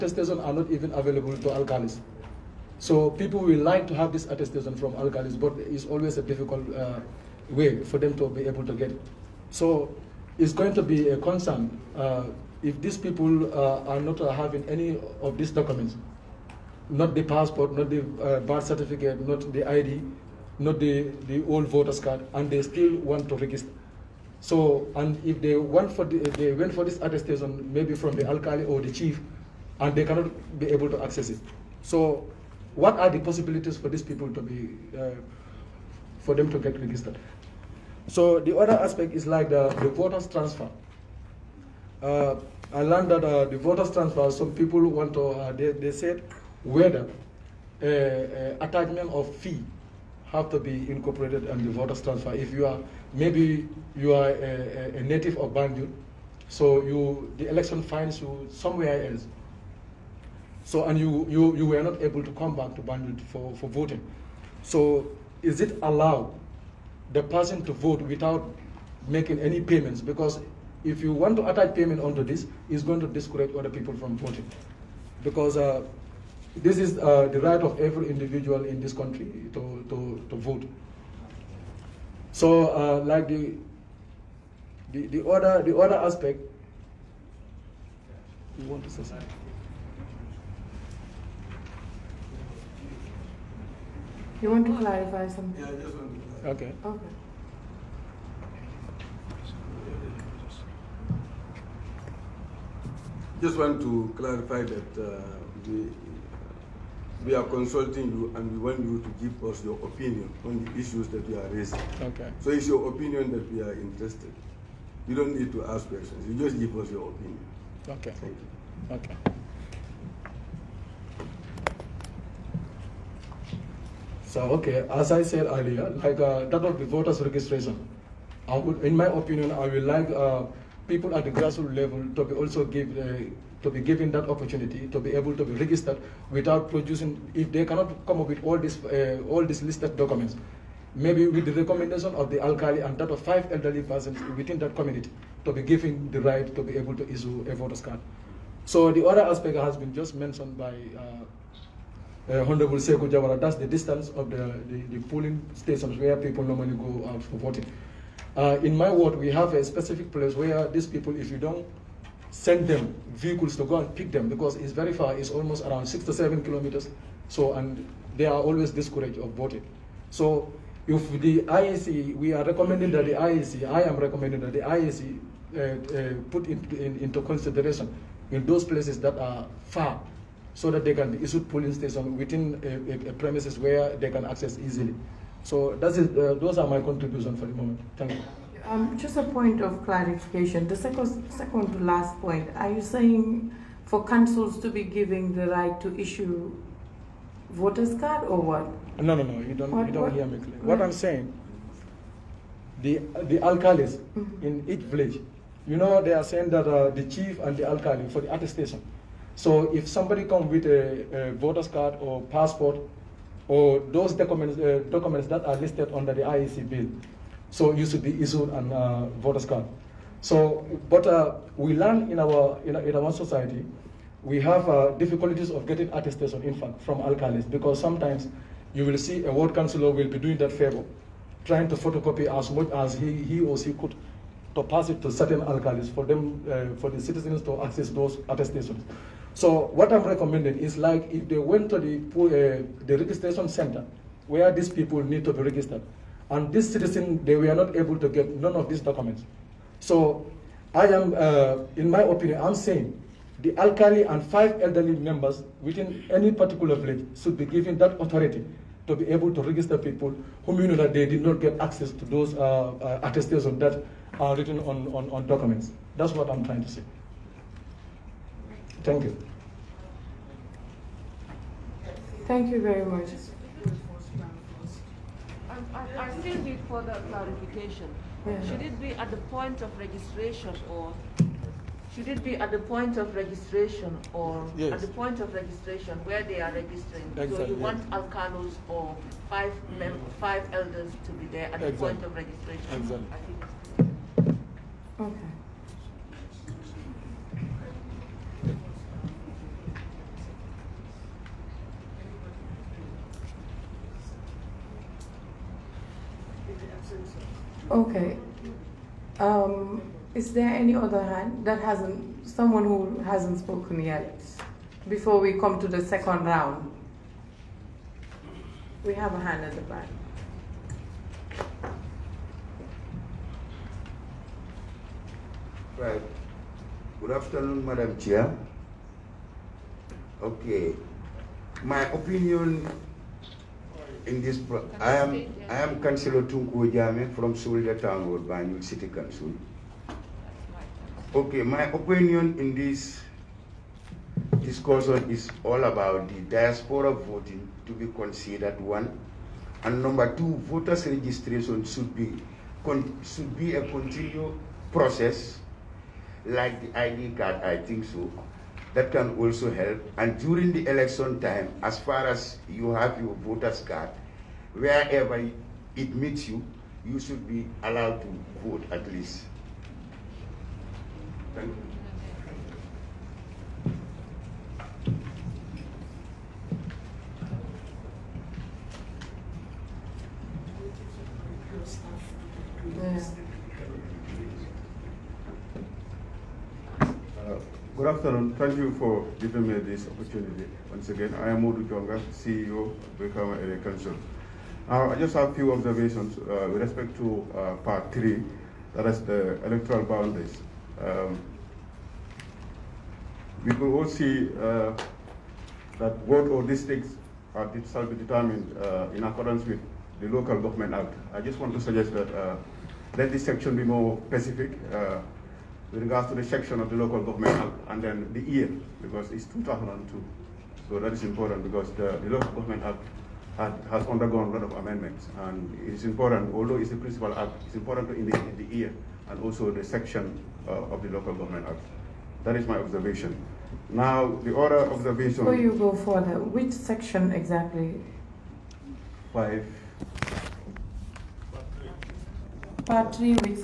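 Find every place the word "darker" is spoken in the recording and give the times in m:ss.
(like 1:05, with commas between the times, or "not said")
not said.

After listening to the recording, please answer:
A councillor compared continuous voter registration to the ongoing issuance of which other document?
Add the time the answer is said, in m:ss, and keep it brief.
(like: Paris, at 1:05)
ID card, at 5:56.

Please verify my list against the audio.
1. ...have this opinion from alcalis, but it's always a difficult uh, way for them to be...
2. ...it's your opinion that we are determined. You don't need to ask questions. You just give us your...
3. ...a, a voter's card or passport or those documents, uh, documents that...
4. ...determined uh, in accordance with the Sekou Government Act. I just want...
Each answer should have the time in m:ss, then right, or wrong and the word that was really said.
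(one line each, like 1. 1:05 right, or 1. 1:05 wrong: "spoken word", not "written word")
1. 0:03 wrong: "attestation", not "opinion"
2. 1:52 wrong: "interested", not "determined"
3. 3:30 right
4. 6:47 wrong: "Local", not "Sekou".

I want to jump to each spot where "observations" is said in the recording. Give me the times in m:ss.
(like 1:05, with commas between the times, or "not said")
6:35, 7:12.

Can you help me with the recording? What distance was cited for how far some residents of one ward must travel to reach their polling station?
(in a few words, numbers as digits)
6 to 7 kilometers.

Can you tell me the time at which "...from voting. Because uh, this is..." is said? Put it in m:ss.
1:13.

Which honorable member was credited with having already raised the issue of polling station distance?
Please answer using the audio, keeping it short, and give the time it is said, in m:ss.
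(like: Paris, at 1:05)
Sekou Jawara, at 2:32.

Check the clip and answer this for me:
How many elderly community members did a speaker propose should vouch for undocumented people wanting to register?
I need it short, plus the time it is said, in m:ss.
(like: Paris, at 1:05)
5, at 2:23.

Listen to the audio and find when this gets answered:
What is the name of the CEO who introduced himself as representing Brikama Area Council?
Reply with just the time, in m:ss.
6:31.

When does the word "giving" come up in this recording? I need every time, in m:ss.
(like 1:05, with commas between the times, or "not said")
3:14, 6:29.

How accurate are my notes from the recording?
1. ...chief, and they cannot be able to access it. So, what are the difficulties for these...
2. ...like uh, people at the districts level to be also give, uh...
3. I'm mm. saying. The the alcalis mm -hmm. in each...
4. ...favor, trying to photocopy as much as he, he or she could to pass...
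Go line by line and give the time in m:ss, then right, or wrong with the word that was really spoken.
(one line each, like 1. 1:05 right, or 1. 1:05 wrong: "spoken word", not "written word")
1. 0:28 wrong: "possibilities", not "difficulties"
2. 2:09 wrong: "grassroots", not "districts"
3. 3:20 right
4. 3:50 right.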